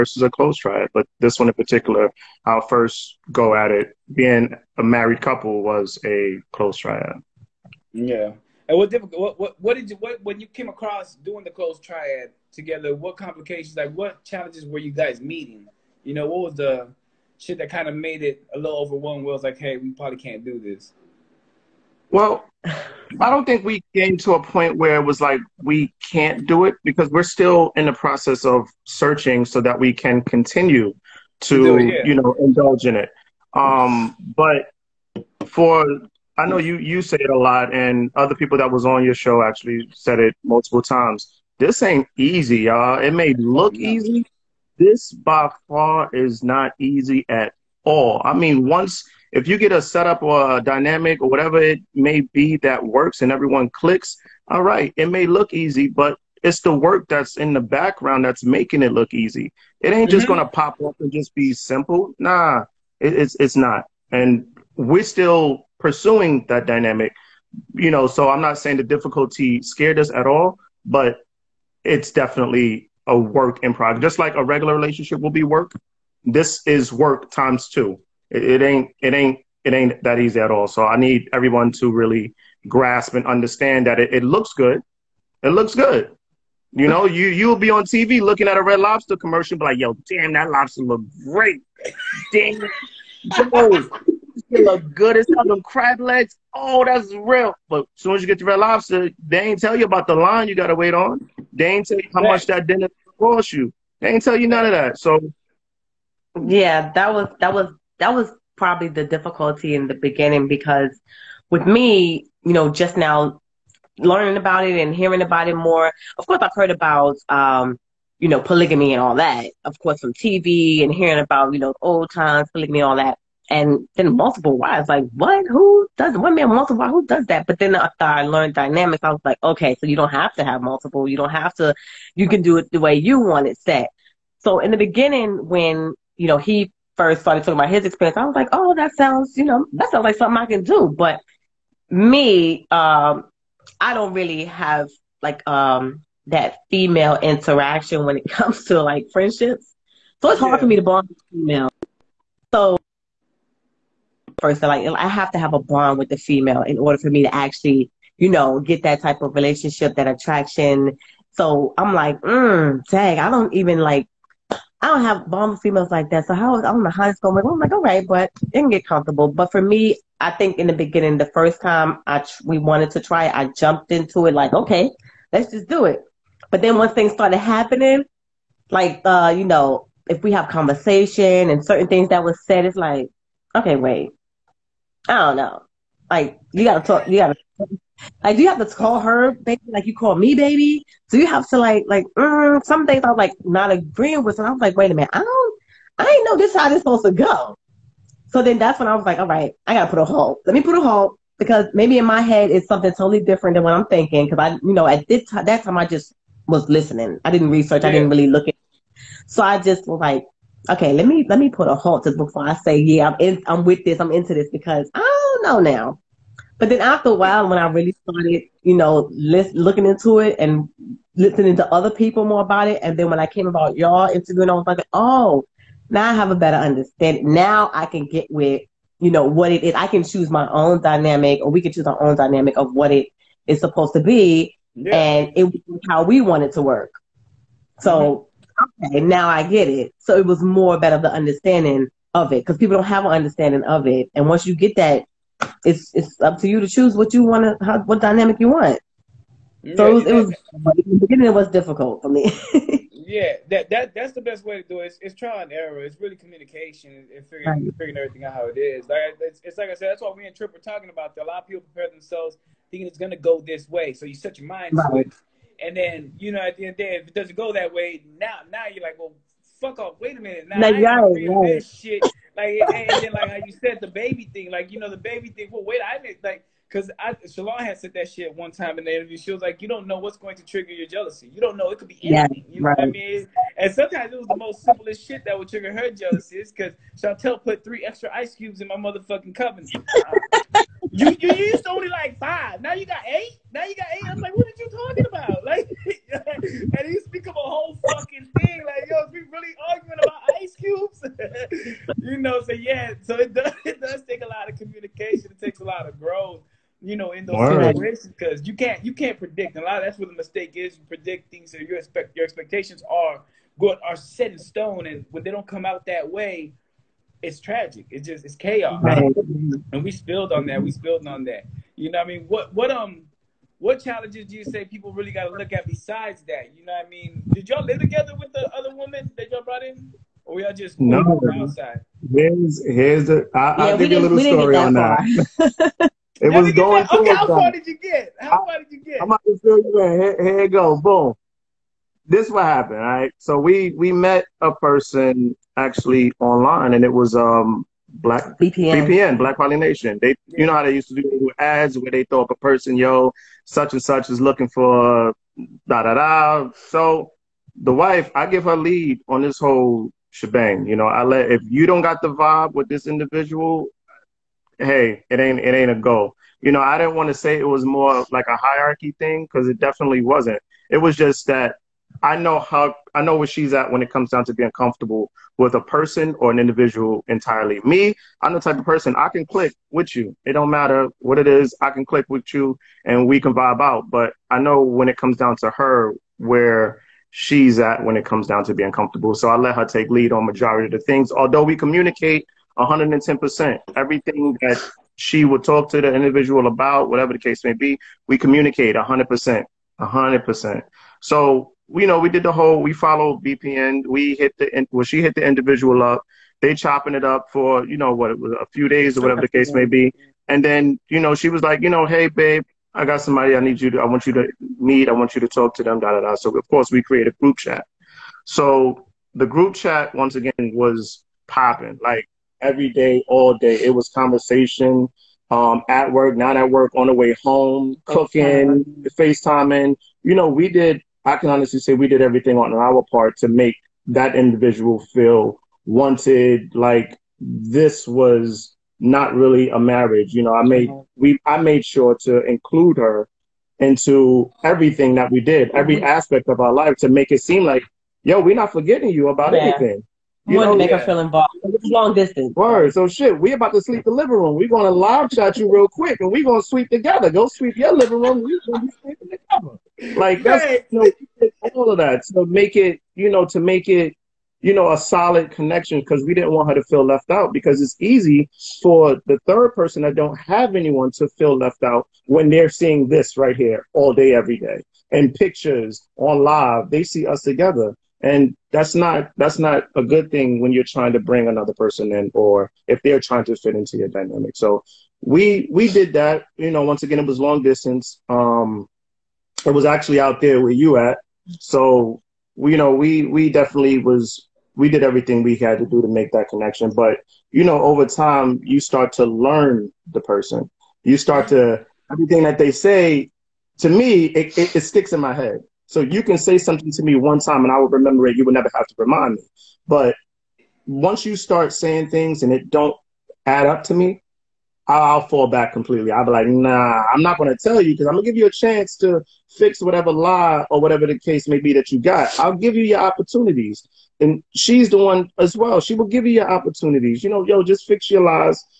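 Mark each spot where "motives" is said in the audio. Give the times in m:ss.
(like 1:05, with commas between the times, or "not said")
not said.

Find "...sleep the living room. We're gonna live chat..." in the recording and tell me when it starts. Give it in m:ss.
7:33.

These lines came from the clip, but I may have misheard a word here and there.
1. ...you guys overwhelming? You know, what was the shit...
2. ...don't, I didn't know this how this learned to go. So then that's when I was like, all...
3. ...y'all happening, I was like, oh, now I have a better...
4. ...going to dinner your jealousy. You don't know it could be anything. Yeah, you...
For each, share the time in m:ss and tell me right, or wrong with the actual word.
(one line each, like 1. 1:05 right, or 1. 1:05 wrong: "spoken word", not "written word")
1. 0:14 wrong: "meeting", not "overwhelming"
2. 3:15 wrong: "supposed", not "learned"
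3. 3:43 wrong: "interviewing", not "happening"
4. 4:40 wrong: "trigger", not "dinner".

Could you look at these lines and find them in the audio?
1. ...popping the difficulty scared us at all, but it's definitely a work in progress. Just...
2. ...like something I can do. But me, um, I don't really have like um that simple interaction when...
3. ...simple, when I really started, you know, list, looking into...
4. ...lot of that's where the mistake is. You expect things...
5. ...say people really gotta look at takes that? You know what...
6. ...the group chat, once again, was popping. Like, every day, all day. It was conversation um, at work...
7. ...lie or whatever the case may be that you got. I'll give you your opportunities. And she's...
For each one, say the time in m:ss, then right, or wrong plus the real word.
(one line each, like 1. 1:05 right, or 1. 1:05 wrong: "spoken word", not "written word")
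1. 1:08 wrong: "saying", not "popping"
2. 2:20 wrong: "female", not "simple"
3. 3:37 wrong: "while", not "simple"
4. 5:09 wrong: "predict", not "expect"
5. 5:24 wrong: "besides", not "takes"
6. 6:59 right
7. 8:39 right.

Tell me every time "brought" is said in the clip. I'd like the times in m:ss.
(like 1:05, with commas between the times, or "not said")
5:29.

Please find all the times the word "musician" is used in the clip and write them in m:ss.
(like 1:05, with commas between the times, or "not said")
not said.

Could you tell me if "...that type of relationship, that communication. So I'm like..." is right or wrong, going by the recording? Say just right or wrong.
wrong.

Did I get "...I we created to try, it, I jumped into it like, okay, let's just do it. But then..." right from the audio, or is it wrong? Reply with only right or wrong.
wrong.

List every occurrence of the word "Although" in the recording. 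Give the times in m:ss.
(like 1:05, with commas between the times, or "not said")
6:31.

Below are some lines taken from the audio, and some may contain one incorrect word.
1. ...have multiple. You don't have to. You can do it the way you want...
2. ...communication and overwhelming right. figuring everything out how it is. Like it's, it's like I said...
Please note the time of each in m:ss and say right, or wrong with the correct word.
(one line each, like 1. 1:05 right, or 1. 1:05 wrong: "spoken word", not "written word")
1. 2:10 right
2. 4:16 wrong: "figuring", not "overwhelming".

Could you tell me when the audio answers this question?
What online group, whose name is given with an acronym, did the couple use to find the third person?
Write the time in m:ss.
5:48.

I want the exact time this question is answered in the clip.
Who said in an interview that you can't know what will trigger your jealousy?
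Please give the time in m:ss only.
4:37.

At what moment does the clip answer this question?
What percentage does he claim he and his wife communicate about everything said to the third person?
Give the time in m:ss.
6:32.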